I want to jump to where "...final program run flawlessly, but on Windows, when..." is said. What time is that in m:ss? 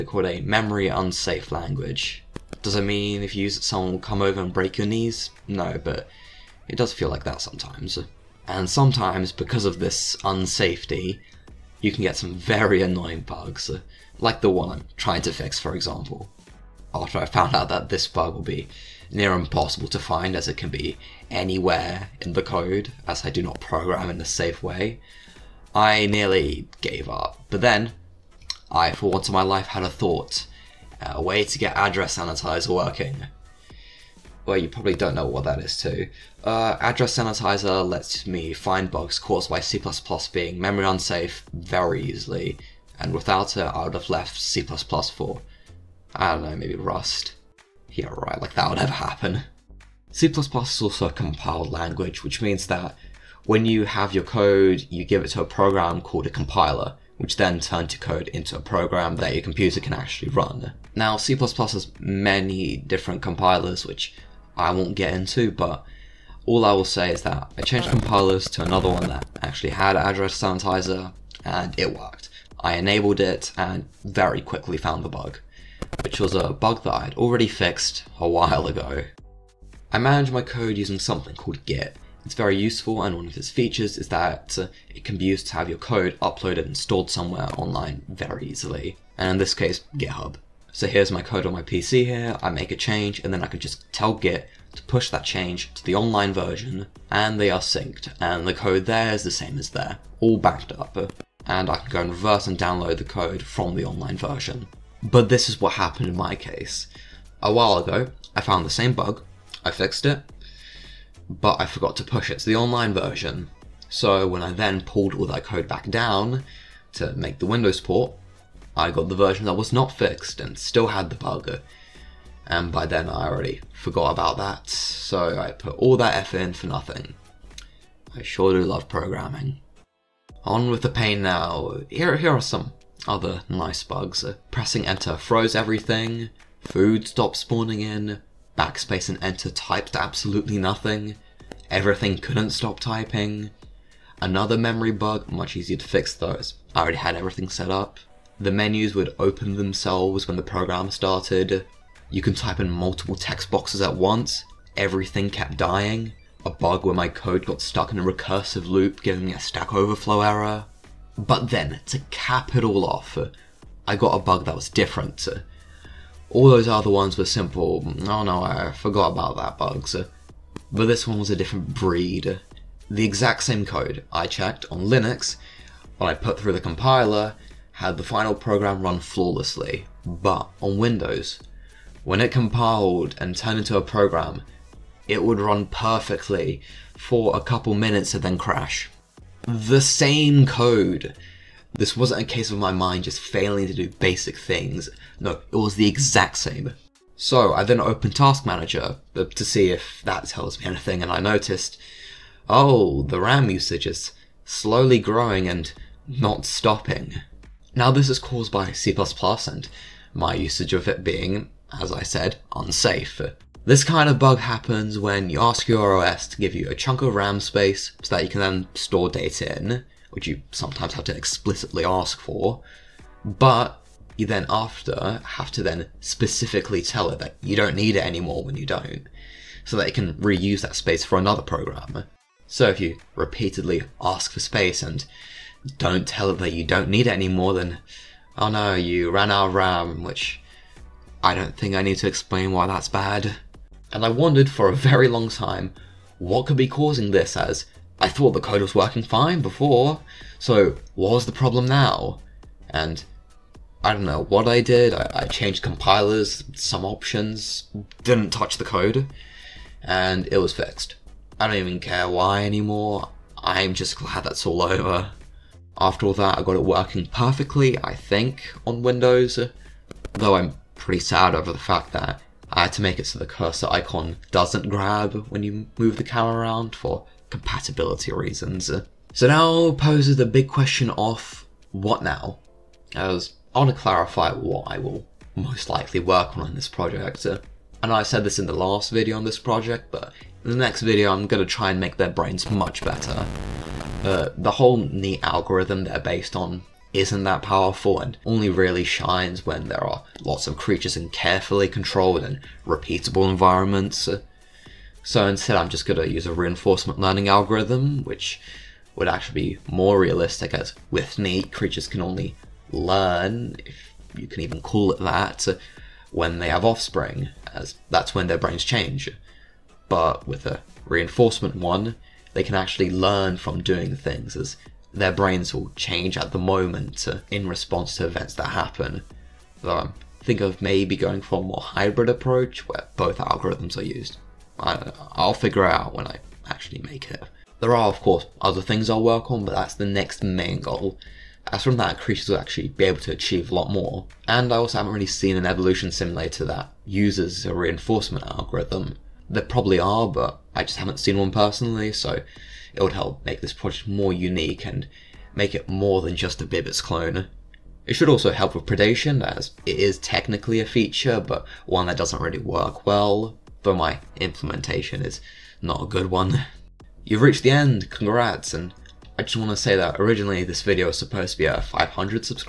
2:58.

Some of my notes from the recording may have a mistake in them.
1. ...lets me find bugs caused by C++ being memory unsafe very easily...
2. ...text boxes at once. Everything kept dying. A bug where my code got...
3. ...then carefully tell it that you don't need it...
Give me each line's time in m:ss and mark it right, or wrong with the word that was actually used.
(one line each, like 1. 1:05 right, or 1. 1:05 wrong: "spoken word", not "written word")
1. 0:37 right
2. 2:33 right
3. 3:45 wrong: "specifically", not "carefully".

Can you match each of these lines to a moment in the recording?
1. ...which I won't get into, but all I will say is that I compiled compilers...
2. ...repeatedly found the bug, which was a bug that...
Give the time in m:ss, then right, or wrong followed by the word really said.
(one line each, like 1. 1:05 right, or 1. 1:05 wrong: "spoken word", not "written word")
1. 1:03 wrong: "changed", not "compiled"
2. 1:14 wrong: "quickly", not "repeatedly".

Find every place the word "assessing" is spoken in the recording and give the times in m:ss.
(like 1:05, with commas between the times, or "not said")
not said.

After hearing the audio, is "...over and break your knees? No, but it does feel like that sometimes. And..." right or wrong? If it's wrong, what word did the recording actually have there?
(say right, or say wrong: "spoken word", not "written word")
right.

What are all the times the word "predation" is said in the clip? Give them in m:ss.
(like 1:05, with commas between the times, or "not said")
5:58.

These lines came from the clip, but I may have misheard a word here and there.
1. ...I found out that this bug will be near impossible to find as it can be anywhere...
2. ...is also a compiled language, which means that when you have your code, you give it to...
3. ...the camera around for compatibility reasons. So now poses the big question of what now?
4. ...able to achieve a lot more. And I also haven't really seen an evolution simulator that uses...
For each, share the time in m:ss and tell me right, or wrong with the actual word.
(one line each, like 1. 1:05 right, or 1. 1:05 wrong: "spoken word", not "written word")
1. 0:17 right
2. 0:50 right
3. 4:35 right
4. 5:42 right.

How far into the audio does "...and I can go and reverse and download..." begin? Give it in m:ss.
1:41.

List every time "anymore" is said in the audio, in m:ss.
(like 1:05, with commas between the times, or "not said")
3:48, 4:22.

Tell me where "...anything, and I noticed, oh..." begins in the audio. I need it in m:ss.
3:20.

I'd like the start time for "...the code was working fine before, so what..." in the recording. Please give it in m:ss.
4:08.